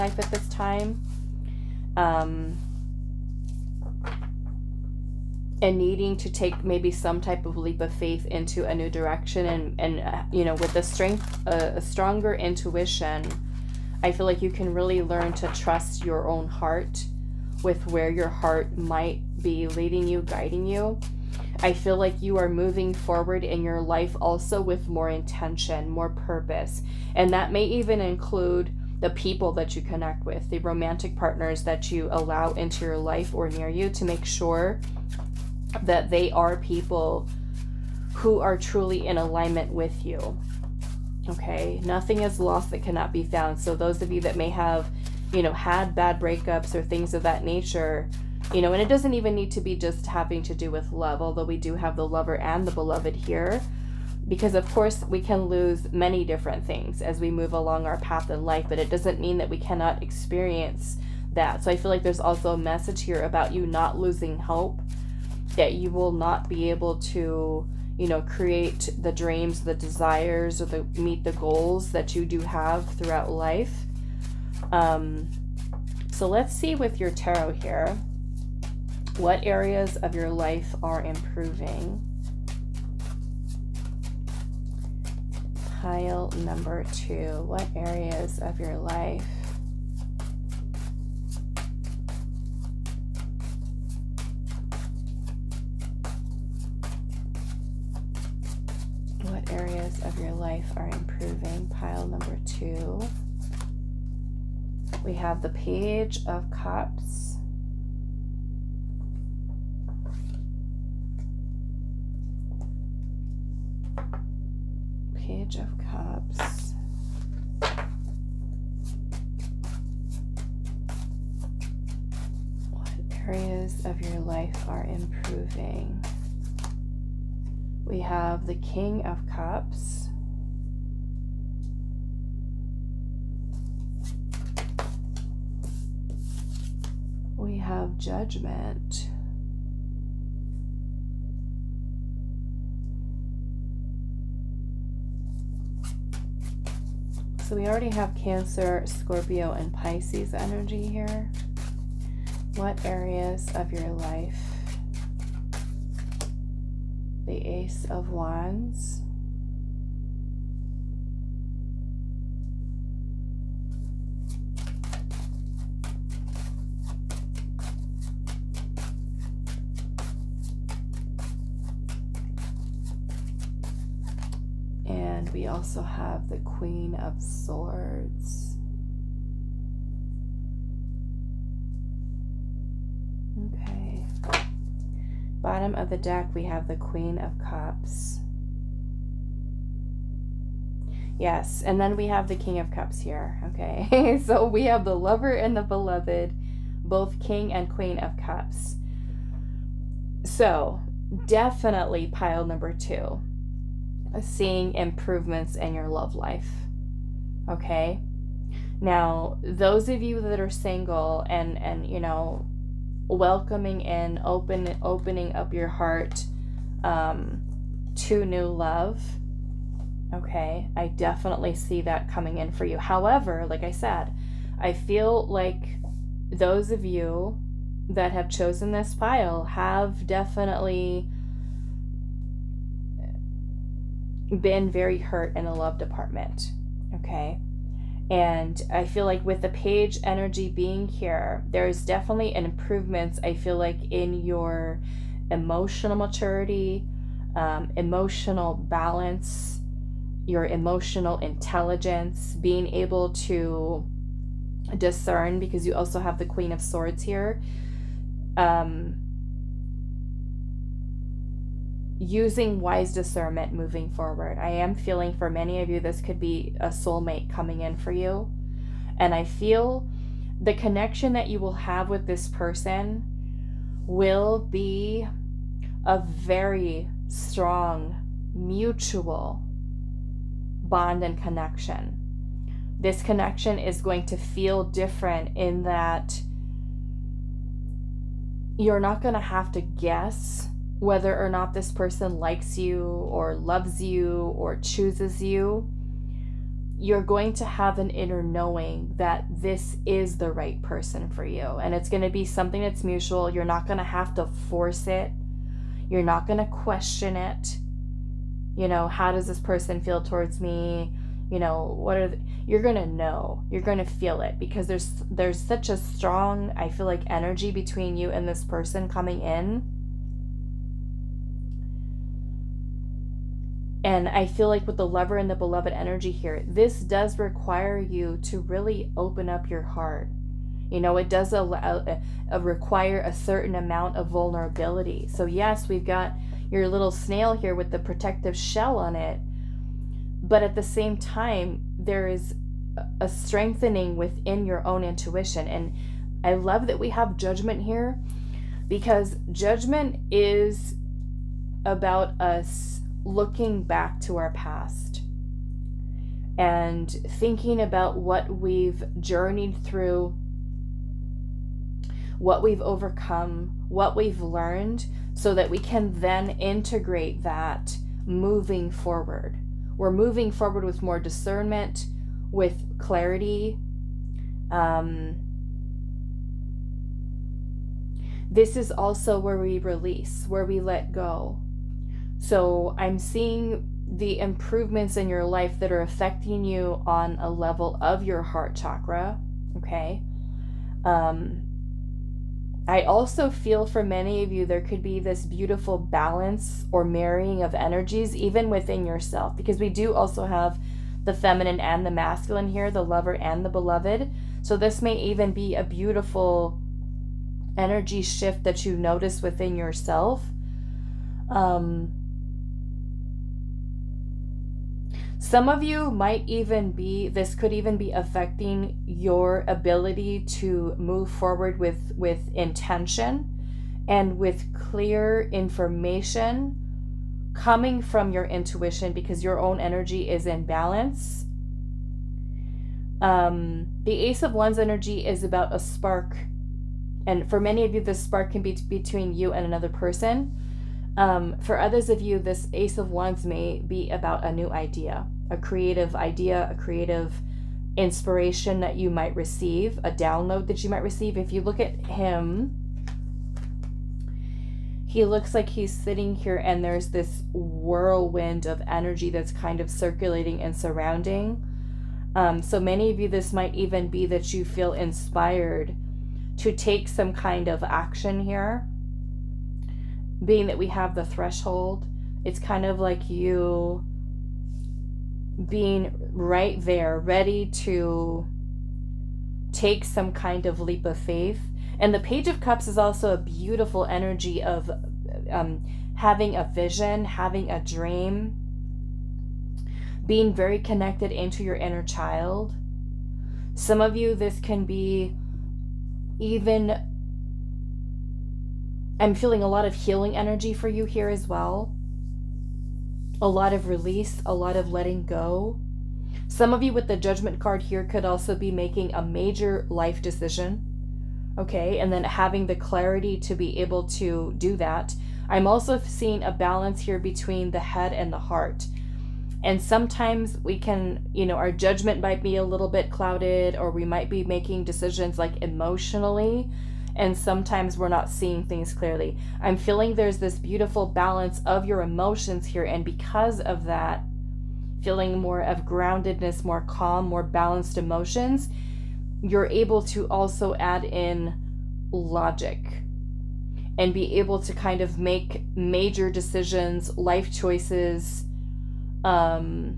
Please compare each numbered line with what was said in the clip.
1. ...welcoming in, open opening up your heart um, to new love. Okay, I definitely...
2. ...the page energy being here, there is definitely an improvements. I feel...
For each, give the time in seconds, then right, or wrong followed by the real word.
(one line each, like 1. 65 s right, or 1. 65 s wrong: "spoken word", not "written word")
1. 213 s right
2. 239 s right.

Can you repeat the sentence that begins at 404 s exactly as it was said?
So this may even be a beautiful energy shift that you notice within yourself.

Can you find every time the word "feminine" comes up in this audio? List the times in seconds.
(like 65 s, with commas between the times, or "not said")
401 s.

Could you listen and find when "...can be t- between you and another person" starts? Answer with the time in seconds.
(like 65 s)
438 s.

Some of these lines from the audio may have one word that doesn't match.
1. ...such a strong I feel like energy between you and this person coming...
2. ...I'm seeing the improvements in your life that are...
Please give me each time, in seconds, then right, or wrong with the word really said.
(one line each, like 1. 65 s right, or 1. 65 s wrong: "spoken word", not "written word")
1. 315 s right
2. 382 s right.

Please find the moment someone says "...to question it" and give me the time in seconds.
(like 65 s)
306 s.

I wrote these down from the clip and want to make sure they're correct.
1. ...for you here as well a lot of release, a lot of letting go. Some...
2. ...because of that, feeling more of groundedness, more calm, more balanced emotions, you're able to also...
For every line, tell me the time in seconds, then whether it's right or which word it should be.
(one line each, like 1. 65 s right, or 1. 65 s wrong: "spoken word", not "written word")
1. 500 s right
2. 532 s right.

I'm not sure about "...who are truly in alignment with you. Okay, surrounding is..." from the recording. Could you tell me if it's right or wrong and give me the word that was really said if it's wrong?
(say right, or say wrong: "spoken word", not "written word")
wrong: "nothing", not "surrounding".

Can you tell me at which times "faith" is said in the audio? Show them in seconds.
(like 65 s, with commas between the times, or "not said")
7 s, 480 s.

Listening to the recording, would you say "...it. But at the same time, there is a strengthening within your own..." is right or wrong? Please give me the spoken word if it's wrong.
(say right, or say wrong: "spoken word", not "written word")
right.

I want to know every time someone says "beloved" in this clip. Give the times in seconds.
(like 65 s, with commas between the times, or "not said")
52 s, 195 s, 325 s, 403 s.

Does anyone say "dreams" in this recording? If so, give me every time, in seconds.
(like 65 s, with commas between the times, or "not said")
69 s, 487 s.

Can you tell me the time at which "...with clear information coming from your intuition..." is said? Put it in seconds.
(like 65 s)
424 s.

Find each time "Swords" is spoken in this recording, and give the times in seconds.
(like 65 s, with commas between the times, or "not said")
177 s, 256 s.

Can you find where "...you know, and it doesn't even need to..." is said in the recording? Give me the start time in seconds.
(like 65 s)
48 s.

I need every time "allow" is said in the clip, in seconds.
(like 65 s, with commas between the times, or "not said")
32 s, 331 s.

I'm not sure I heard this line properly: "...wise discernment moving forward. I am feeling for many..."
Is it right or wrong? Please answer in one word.
right.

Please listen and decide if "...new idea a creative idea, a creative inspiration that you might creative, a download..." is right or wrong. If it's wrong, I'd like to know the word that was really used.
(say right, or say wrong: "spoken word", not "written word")
wrong: "receive", not "creative".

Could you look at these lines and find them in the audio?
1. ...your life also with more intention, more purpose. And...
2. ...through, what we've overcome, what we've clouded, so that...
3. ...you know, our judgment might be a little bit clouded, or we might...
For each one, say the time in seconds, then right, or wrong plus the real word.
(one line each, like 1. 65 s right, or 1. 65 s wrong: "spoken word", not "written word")
1. 23 s right
2. 359 s wrong: "learned", not "clouded"
3. 521 s right.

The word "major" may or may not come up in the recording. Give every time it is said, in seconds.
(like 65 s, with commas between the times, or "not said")
509 s, 545 s.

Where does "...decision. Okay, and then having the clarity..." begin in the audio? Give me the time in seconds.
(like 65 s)
510 s.